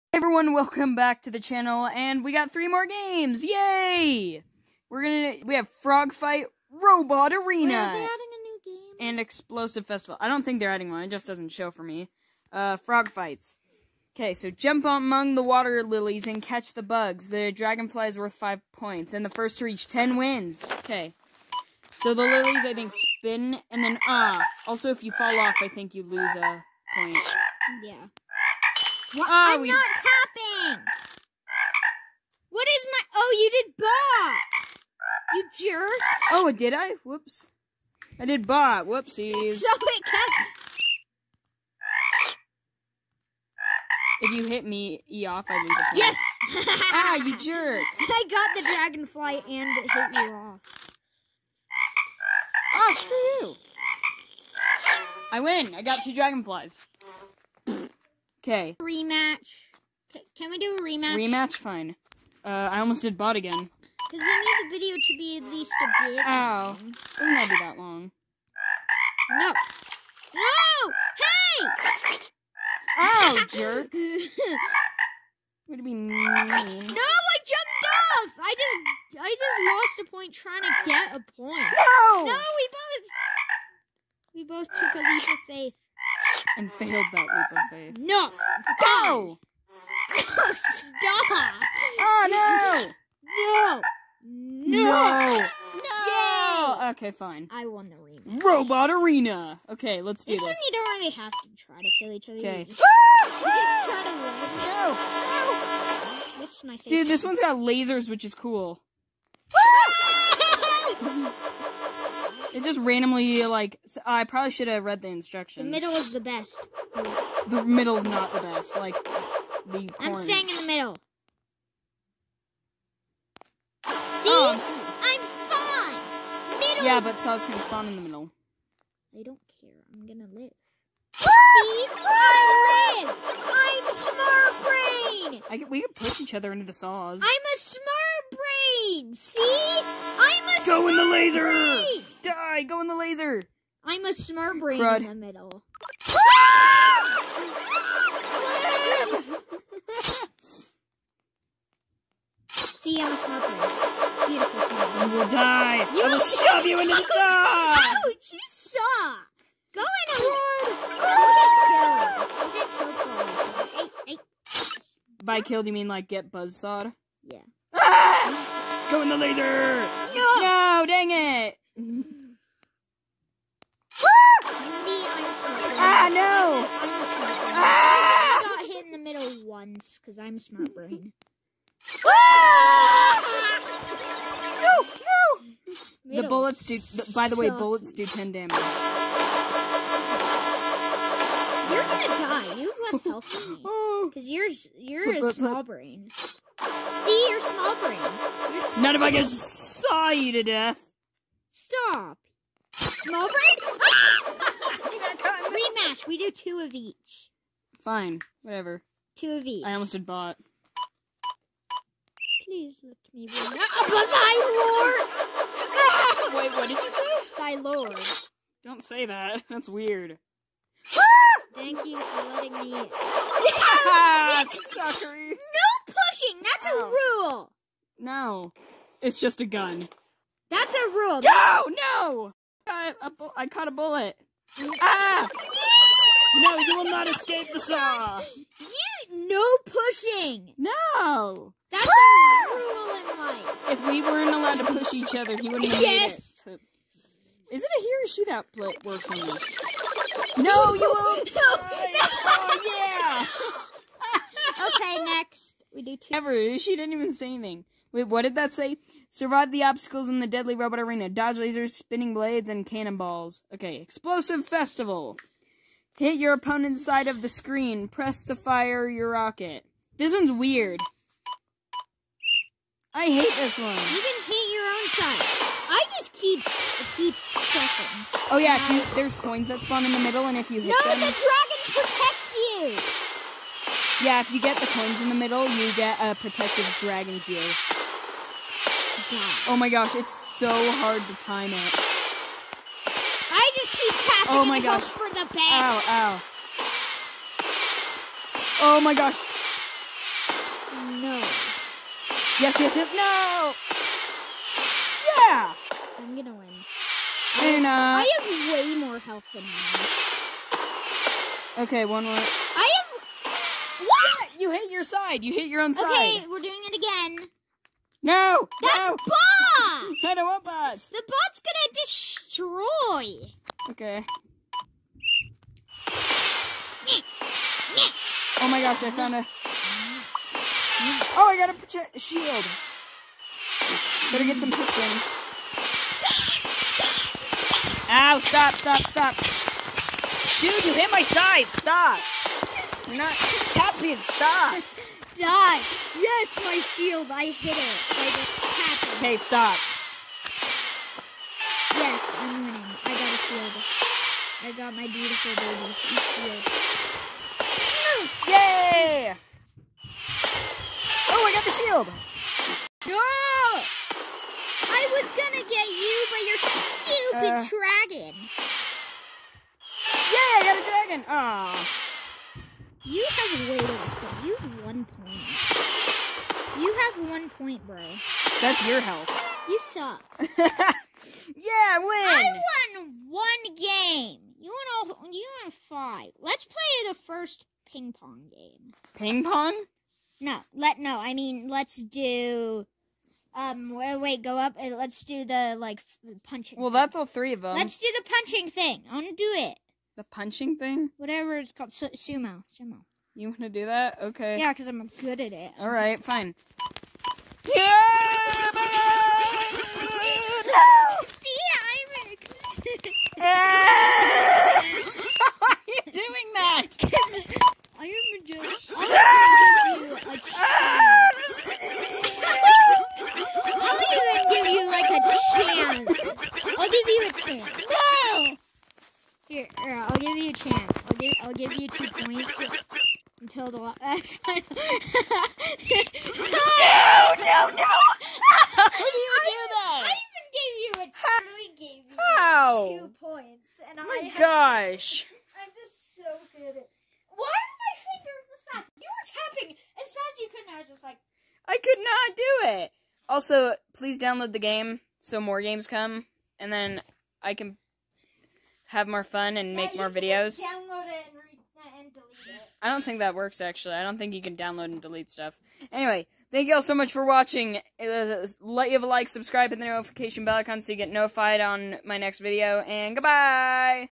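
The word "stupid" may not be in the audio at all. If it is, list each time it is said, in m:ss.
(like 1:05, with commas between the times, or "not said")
6:07.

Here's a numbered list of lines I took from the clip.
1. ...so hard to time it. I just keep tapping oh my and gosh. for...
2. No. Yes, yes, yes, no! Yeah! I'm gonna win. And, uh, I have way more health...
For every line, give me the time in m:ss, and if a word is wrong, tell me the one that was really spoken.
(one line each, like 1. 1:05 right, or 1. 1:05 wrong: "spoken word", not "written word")
1. 4:50 right
2. 5:00 right.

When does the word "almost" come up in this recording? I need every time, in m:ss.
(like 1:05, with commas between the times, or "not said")
1:02, 3:29.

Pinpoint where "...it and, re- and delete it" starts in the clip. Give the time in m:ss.
7:40.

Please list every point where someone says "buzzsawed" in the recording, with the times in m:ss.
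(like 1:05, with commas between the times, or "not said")
2:46.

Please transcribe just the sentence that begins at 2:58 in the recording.
I got hit in the middle once, because I'm smart brain.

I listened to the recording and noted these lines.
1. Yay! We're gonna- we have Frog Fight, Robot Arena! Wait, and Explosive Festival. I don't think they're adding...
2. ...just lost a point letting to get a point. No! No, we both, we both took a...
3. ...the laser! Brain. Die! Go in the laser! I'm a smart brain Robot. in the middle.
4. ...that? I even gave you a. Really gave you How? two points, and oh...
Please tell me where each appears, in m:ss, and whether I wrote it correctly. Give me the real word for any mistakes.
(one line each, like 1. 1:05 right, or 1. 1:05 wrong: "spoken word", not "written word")
1. 0:03 right
2. 1:19 wrong: "trying", not "letting"
3. 2:20 wrong: "Crud", not "Robot"
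4. 7:19 right.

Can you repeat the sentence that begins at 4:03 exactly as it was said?
If we weren't allowed to push each other, he wouldn't have yes.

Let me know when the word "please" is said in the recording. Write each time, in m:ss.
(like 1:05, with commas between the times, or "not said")
3:32, 7:33.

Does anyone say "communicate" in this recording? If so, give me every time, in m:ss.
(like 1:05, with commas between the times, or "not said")
not said.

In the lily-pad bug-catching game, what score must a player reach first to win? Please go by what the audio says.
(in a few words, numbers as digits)
10.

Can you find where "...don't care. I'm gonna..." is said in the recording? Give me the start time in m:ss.
2:09.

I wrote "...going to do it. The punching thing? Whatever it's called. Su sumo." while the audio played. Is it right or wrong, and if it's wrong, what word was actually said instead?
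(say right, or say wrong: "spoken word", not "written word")
right.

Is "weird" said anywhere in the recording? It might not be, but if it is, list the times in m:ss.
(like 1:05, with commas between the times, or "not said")
3:39, 4:30.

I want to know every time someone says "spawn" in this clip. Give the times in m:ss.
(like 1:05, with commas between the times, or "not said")
2:07, 4:39.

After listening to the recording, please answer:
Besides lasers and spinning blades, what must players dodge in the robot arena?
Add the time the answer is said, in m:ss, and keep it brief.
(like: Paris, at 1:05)
Cannonballs, at 4:22.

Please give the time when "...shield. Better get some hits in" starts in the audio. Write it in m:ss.
5:31.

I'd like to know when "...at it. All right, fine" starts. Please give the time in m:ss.
6:45.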